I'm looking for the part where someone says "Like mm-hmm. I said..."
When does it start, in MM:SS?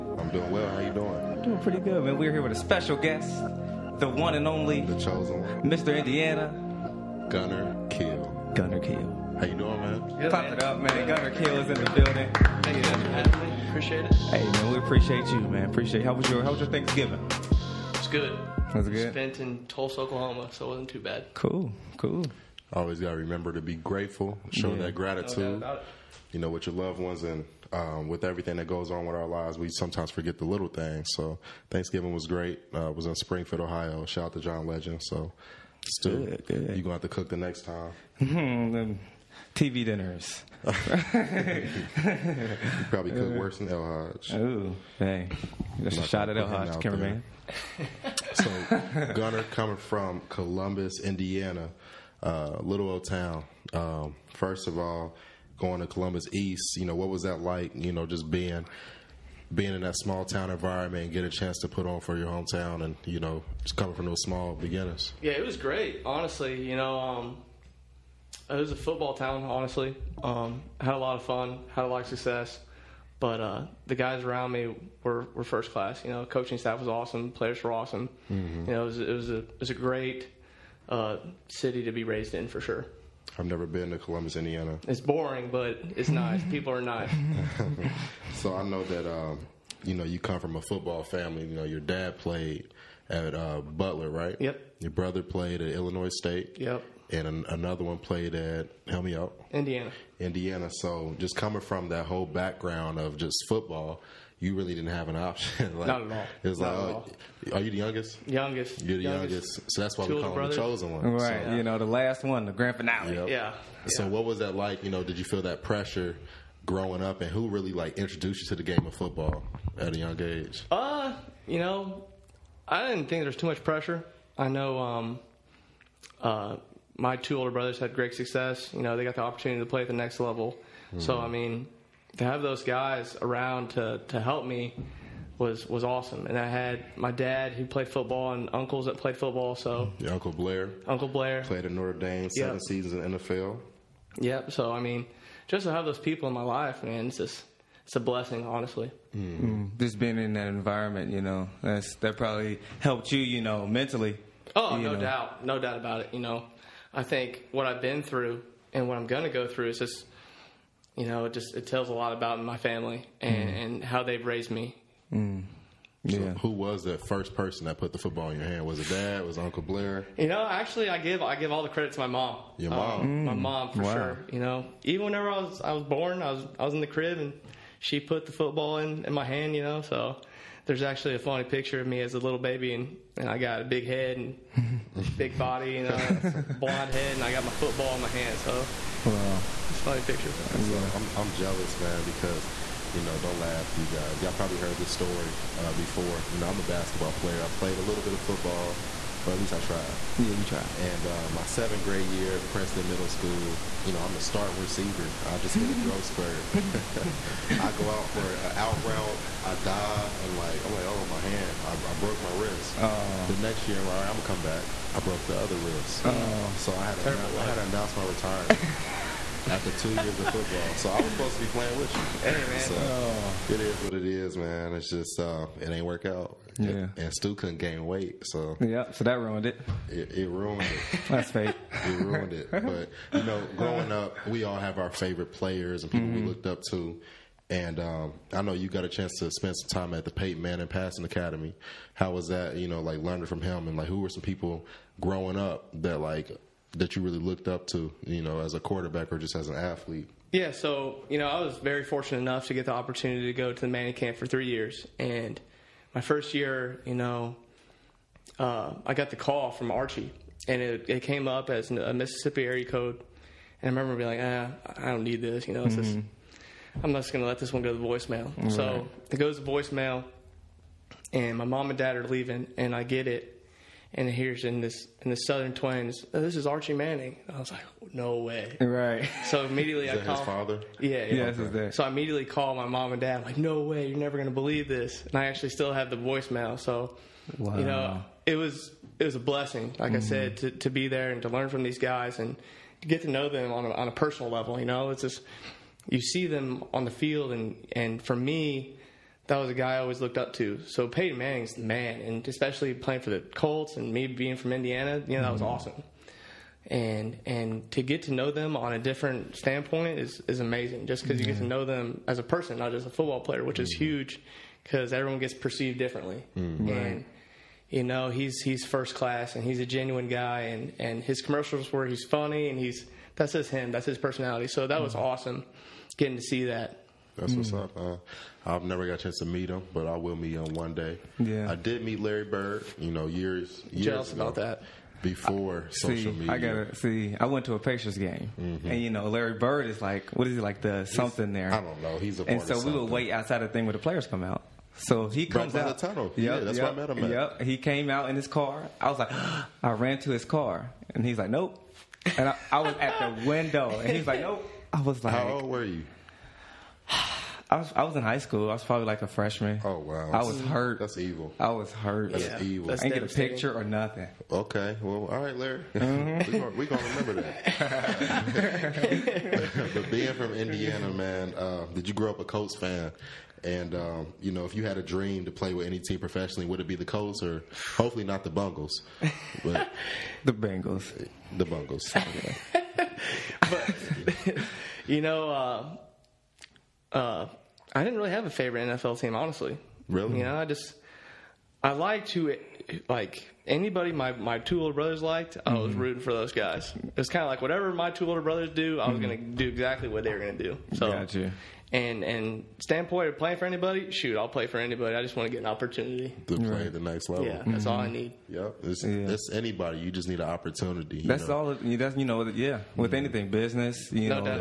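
04:49.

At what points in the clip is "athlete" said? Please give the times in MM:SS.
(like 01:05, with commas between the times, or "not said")
04:09.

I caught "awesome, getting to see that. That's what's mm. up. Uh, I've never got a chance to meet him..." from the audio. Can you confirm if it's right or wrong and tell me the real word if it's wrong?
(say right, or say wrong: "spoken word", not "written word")
right.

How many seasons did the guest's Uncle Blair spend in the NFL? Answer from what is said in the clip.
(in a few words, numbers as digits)
7.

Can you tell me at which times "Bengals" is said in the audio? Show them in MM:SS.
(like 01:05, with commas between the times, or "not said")
06:20.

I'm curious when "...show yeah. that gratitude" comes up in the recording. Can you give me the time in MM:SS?
00:24.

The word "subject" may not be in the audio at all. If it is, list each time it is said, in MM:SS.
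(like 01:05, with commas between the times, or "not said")
not said.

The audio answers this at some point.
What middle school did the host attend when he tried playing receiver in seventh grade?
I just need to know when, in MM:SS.
03:22.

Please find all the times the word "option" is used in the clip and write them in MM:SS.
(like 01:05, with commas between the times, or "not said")
01:45.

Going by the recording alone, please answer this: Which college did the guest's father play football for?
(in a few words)
Butler.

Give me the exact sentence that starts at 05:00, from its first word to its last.
So Peyton Manning's the man, and especially playing for the Colts and me being from Indiana, you know, that was mm-hmm.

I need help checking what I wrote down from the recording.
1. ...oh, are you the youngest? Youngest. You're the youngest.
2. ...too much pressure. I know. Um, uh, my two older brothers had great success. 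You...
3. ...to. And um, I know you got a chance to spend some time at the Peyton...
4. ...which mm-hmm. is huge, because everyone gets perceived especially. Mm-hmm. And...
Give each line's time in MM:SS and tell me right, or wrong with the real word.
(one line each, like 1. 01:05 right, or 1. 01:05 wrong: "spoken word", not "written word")
1. 01:46 right
2. 02:03 right
3. 03:56 right
4. 05:13 wrong: "differently", not "especially".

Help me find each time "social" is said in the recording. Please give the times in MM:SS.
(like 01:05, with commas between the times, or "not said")
05:35.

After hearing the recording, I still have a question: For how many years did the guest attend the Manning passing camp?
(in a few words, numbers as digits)
3.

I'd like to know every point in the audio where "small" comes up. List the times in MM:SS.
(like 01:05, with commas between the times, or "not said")
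00:59, 01:04.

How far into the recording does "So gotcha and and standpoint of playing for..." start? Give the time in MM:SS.
06:40.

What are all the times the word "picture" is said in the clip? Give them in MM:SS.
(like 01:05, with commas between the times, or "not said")
03:01, 03:10, 06:03.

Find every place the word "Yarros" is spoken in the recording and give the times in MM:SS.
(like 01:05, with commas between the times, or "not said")
not said.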